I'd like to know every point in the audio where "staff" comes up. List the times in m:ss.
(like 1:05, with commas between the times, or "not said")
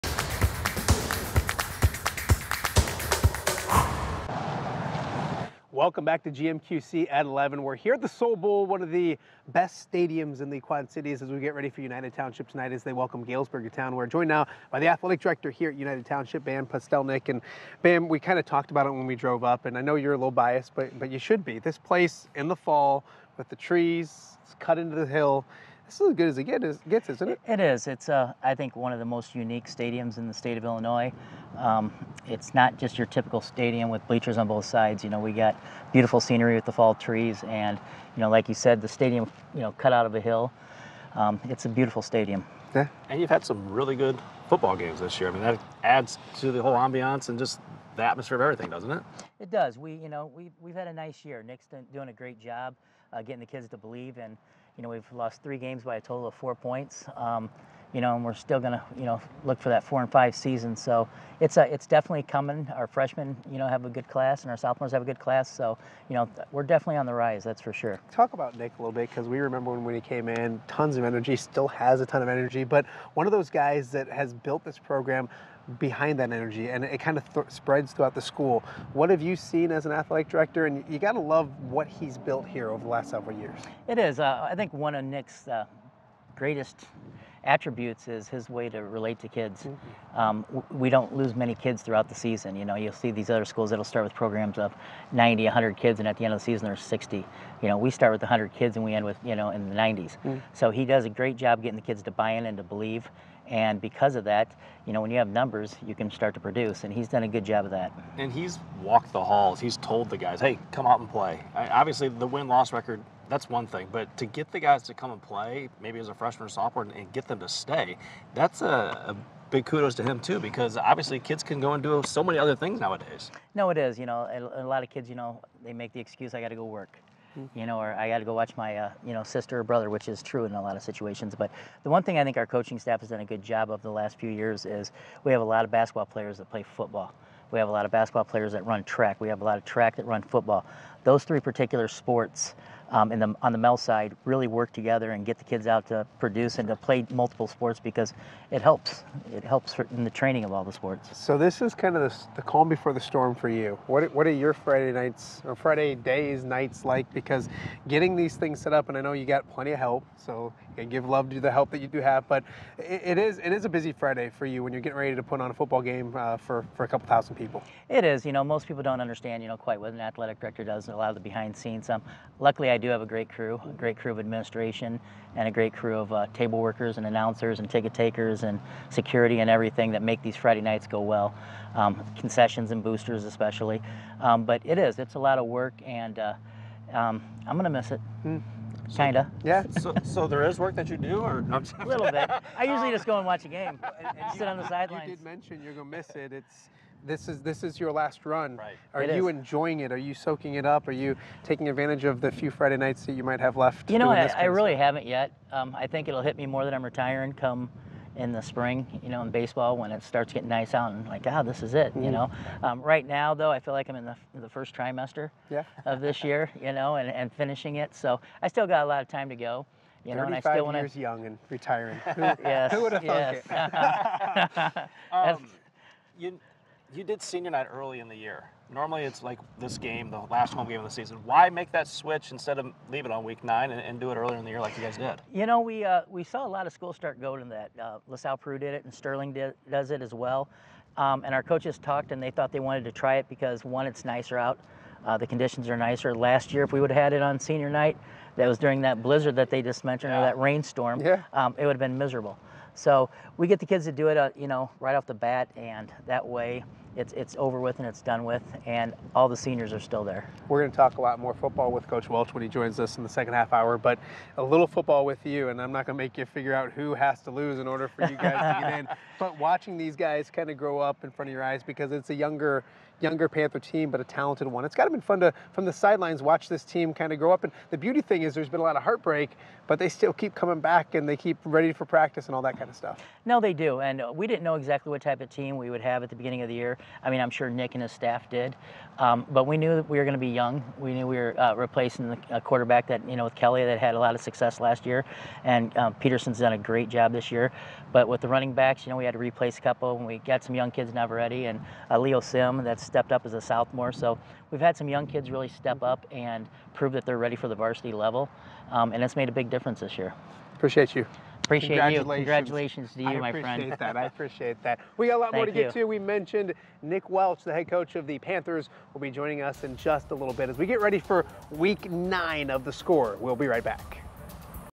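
2:12, 4:47.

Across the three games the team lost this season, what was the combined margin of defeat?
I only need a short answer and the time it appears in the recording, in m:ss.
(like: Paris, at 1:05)
4 points, at 0:56.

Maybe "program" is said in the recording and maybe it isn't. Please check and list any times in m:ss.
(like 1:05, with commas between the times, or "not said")
1:14, 1:34.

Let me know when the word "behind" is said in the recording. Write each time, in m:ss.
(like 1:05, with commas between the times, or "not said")
1:15, 2:51.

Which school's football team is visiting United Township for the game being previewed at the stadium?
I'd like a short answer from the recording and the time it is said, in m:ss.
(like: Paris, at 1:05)
Galesburg, at 0:13.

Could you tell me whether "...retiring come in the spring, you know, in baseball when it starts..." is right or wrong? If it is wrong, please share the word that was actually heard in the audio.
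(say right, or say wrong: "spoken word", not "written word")
right.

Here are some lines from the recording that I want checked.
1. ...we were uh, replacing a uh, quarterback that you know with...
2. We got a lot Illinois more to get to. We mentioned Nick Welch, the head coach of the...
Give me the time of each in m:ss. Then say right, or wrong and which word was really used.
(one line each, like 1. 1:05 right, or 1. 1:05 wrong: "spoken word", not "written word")
1. 4:51 right
2. 5:14 wrong: "Thank", not "Illinois".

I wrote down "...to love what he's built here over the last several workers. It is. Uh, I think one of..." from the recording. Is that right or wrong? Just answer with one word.
wrong.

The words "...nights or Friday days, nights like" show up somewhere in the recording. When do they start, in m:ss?
2:34.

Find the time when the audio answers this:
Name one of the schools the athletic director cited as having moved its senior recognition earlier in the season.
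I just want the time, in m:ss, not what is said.
3:58.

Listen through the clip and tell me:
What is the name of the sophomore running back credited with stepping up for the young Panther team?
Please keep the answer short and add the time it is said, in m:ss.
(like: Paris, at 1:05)
Leo Sim, at 5:01.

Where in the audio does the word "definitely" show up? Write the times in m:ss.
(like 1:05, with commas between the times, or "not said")
1:01, 1:06.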